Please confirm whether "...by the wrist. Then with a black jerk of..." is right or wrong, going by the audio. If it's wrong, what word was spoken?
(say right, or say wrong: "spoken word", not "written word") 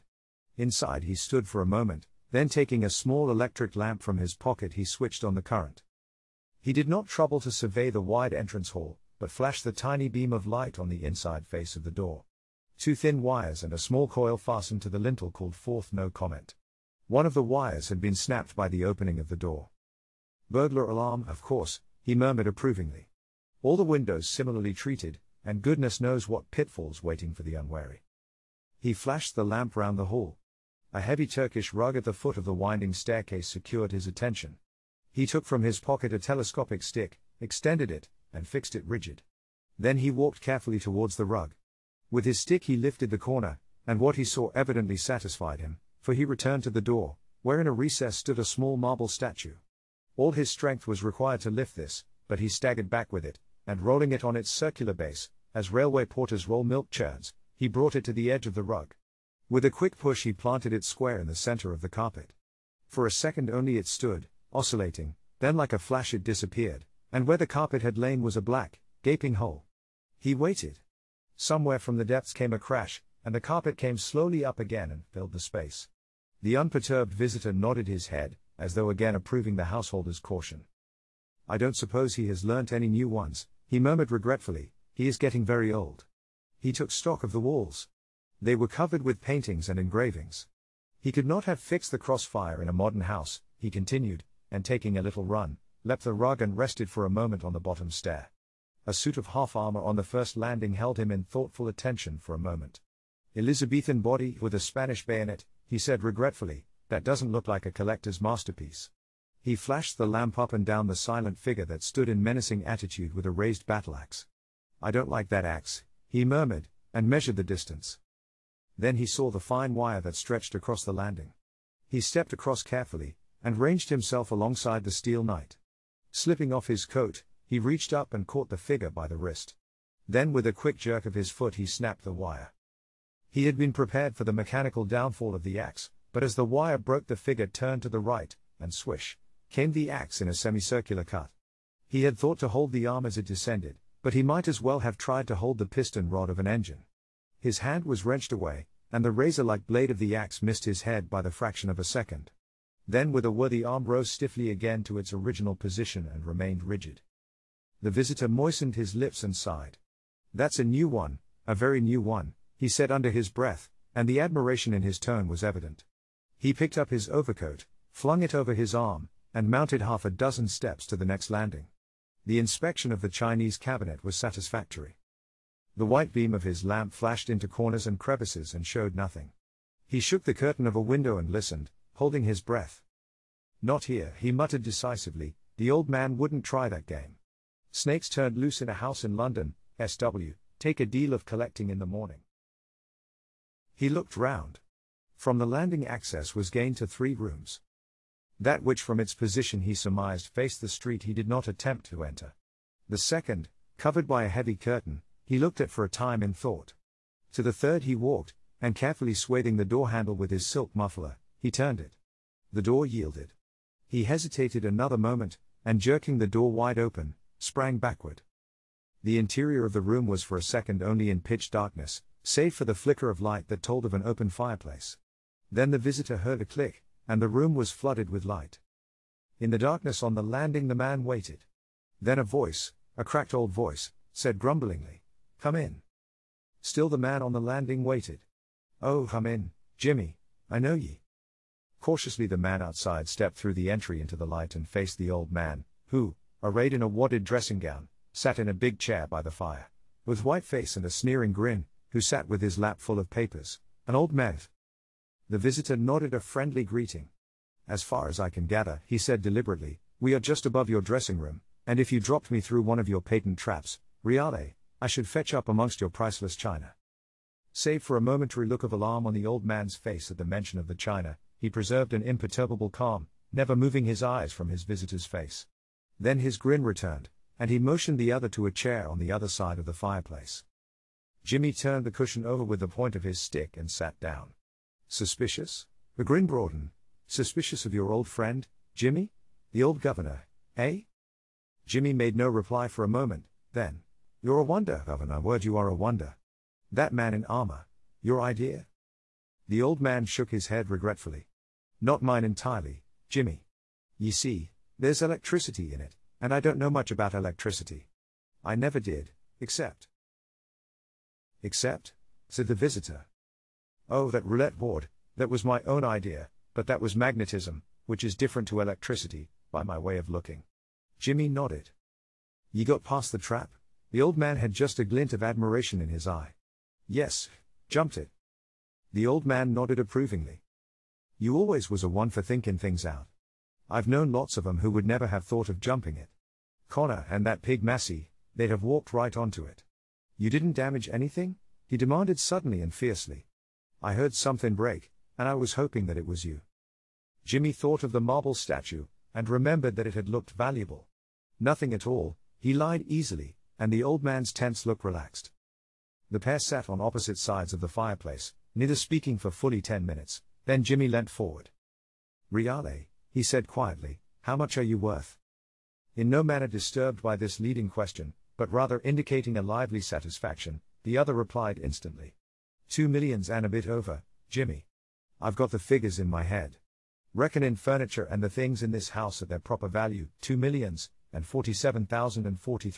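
wrong: "quick", not "black".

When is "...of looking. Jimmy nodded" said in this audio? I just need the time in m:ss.
5:19.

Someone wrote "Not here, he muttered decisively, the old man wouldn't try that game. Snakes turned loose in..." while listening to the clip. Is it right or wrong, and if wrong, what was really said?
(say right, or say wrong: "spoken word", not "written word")
right.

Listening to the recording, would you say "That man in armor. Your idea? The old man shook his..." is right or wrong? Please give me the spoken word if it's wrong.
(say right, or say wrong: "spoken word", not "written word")
right.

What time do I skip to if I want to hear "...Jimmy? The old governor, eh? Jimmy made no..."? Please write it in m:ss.
4:48.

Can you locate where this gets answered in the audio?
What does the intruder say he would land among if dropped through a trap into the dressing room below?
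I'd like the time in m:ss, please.
4:25.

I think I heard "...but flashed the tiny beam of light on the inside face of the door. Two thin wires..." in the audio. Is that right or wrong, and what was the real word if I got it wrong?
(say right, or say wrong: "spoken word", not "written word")
right.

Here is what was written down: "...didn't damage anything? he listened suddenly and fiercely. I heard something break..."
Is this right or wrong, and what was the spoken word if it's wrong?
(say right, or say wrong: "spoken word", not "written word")
wrong: "demanded", not "listened".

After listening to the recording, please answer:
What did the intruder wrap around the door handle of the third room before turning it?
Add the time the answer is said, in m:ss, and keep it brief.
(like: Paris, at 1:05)
Silk muffler, at 3:30.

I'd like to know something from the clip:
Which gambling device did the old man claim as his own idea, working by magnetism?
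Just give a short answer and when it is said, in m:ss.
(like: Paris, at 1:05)
Roulette board, at 5:14.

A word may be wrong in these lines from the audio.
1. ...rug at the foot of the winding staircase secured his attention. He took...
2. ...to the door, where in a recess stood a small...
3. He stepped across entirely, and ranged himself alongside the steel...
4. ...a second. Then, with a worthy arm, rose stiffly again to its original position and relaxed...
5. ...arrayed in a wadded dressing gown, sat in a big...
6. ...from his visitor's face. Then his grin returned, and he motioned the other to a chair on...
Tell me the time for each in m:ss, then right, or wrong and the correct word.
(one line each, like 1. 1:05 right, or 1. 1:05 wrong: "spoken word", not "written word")
1. 0:31 right
2. 0:46 right
3. 2:01 wrong: "carefully", not "entirely"
4. 2:31 wrong: "remained", not "relaxed"
5. 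4:06 right
6. 4:34 right.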